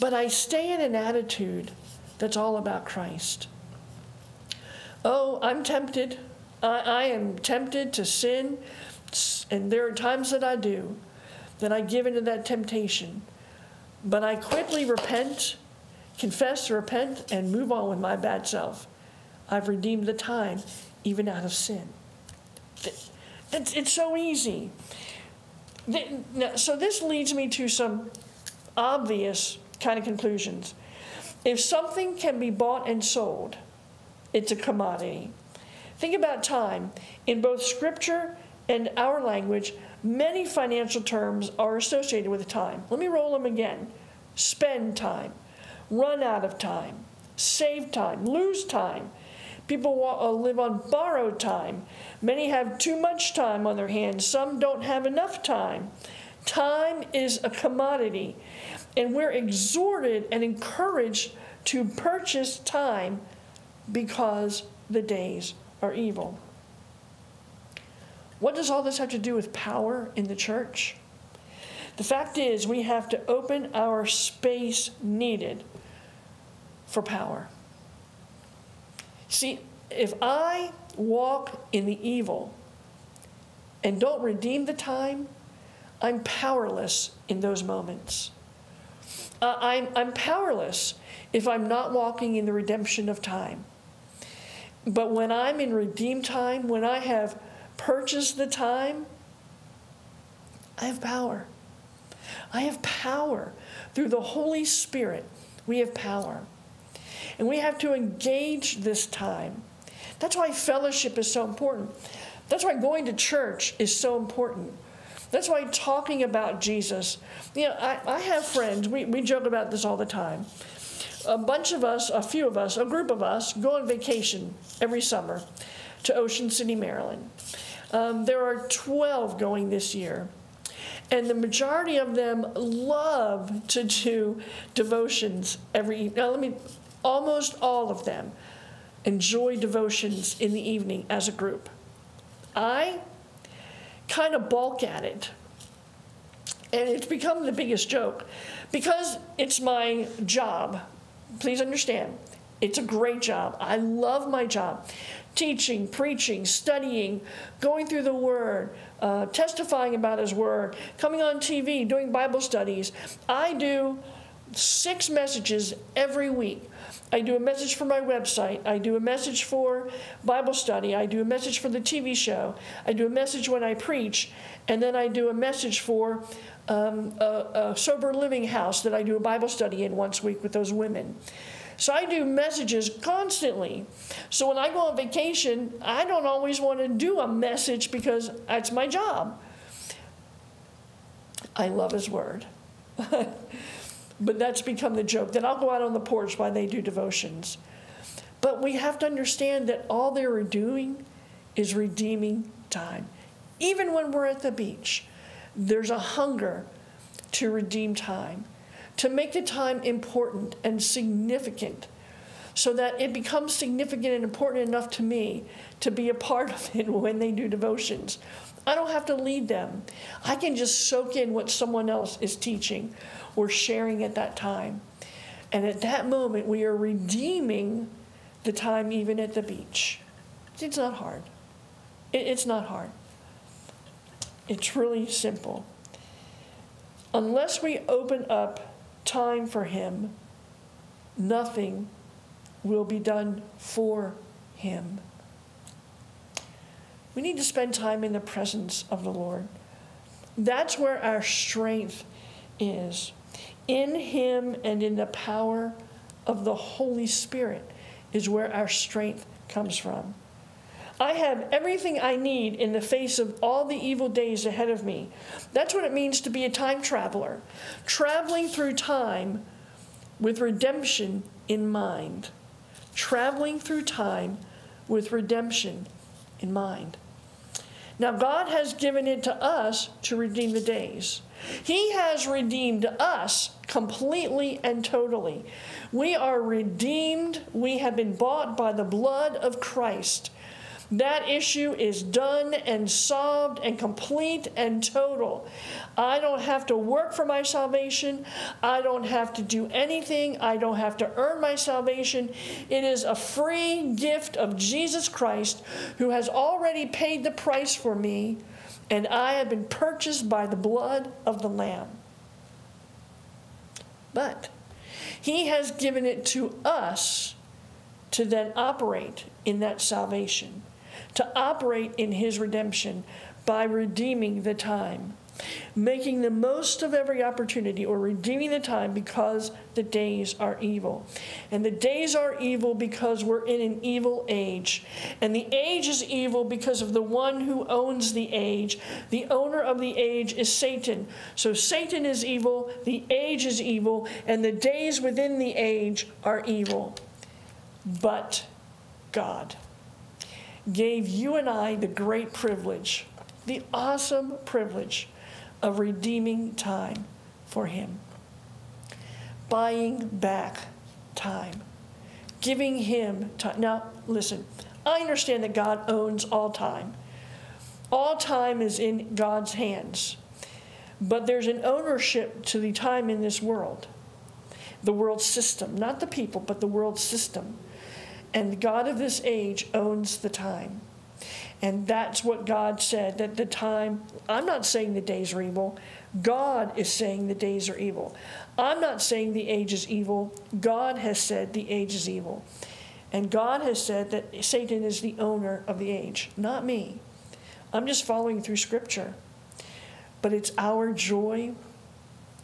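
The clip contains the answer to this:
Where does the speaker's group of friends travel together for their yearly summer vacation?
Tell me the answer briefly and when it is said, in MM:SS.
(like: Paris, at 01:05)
Ocean City, Maryland, at 02:06.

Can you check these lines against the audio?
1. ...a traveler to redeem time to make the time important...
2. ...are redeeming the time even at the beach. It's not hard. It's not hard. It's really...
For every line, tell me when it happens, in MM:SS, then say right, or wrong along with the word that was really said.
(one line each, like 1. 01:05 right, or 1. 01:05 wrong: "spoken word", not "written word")
1. 03:25 wrong: "hunger", not "traveler"
2. 03:46 right.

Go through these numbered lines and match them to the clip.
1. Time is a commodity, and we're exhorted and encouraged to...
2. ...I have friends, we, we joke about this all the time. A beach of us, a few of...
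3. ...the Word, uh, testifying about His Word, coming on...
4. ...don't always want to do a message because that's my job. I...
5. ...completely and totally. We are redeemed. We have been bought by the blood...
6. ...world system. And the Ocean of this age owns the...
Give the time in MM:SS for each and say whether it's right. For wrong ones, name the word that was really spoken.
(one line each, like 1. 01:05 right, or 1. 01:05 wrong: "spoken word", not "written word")
1. 00:56 right
2. 01:58 wrong: "bunch", not "beach"
3. 02:38 right
4. 03:06 right
5. 04:43 right
6. 06:16 wrong: "God", not "Ocean".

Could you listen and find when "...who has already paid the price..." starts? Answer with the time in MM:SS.
05:05.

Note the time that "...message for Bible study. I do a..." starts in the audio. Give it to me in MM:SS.
02:48.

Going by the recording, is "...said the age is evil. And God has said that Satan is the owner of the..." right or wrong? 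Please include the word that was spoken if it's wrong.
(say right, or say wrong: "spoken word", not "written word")
right.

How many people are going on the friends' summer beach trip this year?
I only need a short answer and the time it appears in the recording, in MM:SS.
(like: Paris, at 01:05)
12, at 02:08.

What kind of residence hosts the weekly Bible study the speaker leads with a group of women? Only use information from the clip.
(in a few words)
sober living house.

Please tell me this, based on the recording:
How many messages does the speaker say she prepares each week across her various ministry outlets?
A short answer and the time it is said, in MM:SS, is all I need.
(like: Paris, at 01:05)
6, at 02:44.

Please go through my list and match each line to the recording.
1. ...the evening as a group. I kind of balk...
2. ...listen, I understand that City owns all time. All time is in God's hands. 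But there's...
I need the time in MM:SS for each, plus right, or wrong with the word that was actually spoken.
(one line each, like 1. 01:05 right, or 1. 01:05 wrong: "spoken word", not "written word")
1. 02:20 right
2. 06:04 wrong: "God", not "City".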